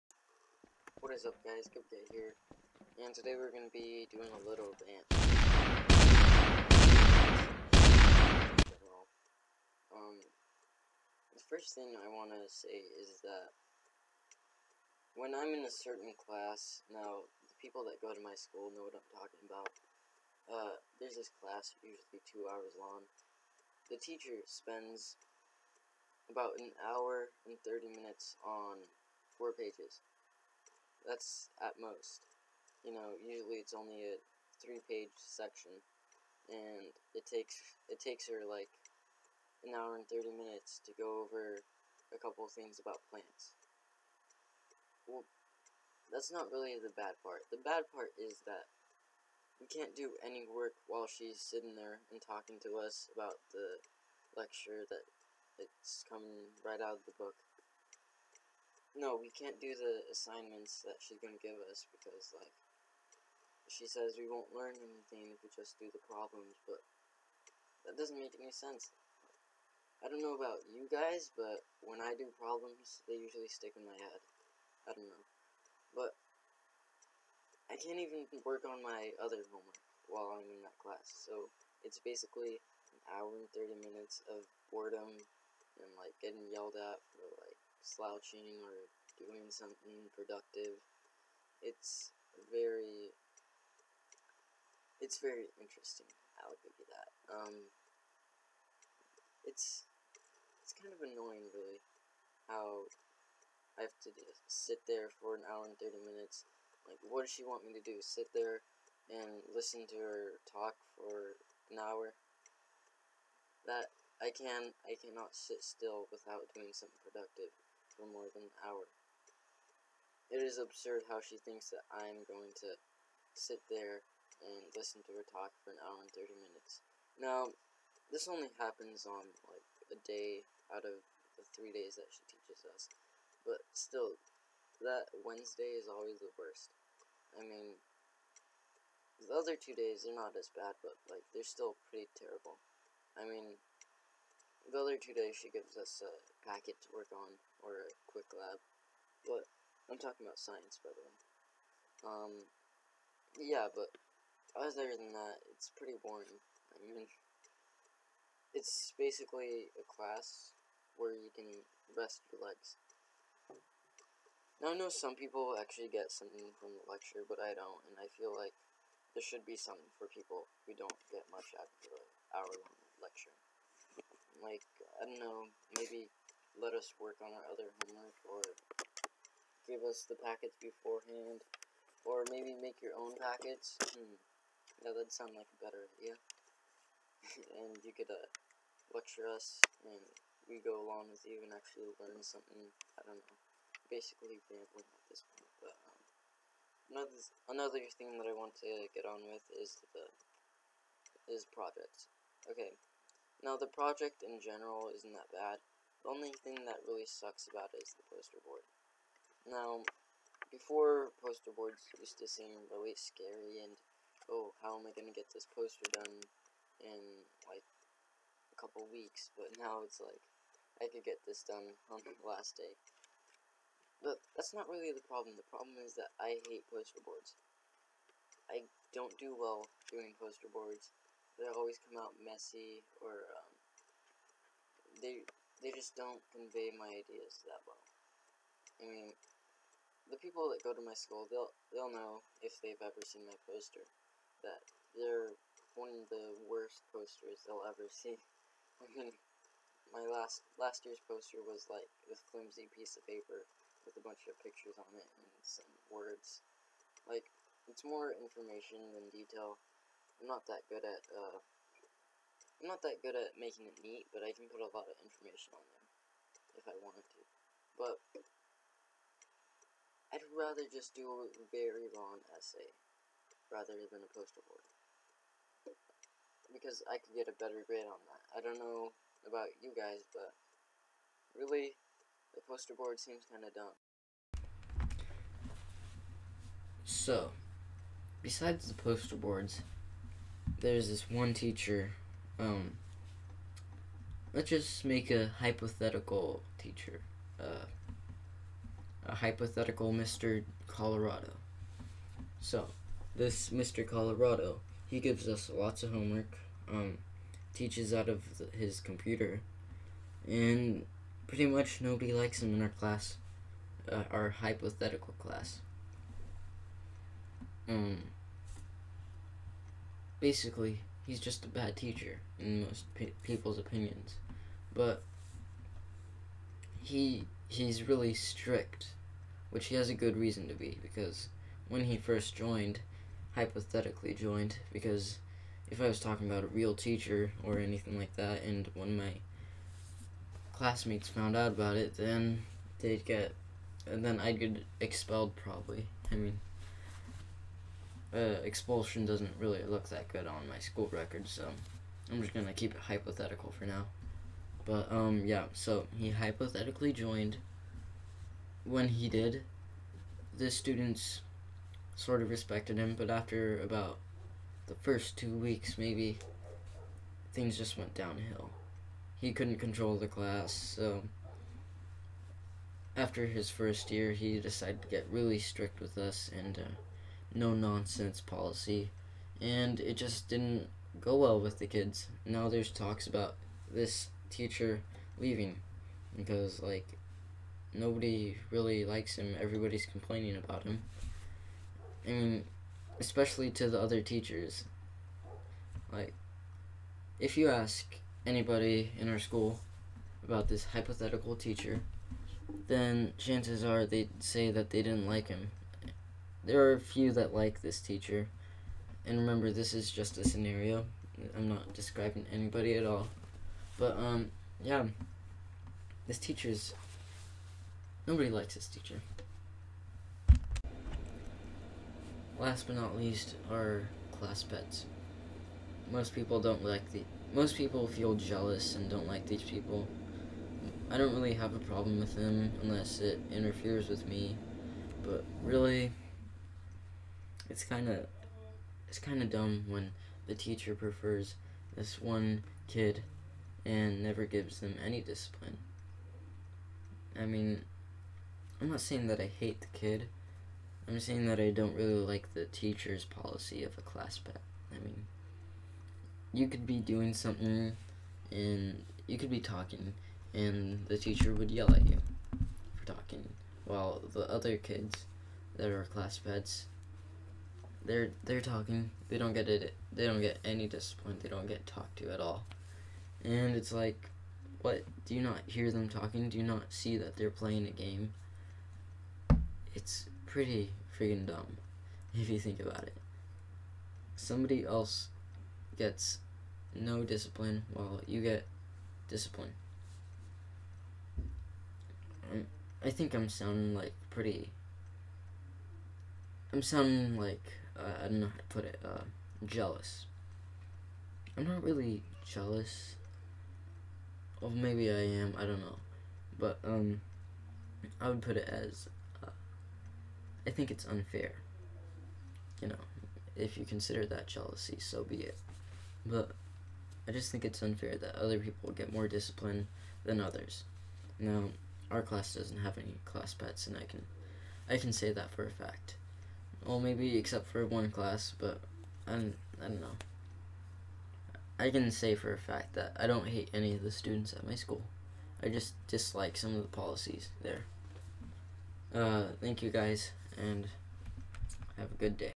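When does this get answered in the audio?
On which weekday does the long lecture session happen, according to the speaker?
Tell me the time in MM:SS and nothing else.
02:15.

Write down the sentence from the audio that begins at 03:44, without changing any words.
But that's not really the problem.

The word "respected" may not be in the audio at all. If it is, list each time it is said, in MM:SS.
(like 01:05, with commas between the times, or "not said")
06:02.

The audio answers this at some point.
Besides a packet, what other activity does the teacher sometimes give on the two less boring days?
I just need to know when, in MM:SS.
02:27.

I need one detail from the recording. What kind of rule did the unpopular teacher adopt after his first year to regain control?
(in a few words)
no nonsense policy.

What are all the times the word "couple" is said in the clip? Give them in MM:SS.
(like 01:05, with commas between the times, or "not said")
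00:42, 03:38.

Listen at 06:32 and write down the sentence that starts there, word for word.
I mean, especially to the other teachers.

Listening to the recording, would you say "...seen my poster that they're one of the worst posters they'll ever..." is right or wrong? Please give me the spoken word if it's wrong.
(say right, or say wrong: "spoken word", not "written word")
right.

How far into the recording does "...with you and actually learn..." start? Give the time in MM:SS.
03:11.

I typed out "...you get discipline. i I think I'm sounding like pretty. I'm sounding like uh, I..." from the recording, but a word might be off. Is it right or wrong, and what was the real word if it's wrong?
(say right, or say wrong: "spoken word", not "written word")
right.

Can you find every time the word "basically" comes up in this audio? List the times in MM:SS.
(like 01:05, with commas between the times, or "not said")
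01:21, 02:38, 03:13, 05:20.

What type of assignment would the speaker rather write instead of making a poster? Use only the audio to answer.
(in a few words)
a very long essay.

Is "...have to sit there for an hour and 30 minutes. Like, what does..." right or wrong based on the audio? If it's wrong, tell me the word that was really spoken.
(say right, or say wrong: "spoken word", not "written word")
right.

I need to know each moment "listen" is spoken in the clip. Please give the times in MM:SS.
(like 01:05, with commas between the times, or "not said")
01:49, 02:04.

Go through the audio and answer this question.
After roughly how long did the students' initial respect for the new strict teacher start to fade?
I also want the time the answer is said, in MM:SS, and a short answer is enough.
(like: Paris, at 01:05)
2 weeks, at 06:04.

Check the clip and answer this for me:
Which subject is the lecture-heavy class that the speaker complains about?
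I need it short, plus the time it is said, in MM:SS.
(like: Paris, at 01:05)
science, at 02:30.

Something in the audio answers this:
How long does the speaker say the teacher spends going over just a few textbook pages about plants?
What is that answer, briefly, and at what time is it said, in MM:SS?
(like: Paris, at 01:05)
1 hour 30 minutes, at 00:26.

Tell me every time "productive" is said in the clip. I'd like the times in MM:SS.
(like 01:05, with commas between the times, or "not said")
01:30, 01:57.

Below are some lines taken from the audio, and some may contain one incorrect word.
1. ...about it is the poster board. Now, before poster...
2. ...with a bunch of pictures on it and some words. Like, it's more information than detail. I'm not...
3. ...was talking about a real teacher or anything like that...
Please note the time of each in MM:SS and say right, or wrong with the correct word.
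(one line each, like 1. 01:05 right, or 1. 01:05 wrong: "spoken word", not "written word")
1. 03:27 right
2. 04:13 right
3. 05:35 right.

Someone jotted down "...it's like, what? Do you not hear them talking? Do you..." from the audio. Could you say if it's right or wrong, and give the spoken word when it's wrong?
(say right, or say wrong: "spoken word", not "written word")
right.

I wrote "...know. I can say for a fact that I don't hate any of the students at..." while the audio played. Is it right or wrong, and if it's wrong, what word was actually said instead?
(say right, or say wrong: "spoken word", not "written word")
right.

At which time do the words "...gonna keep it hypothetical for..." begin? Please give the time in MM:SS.
05:52.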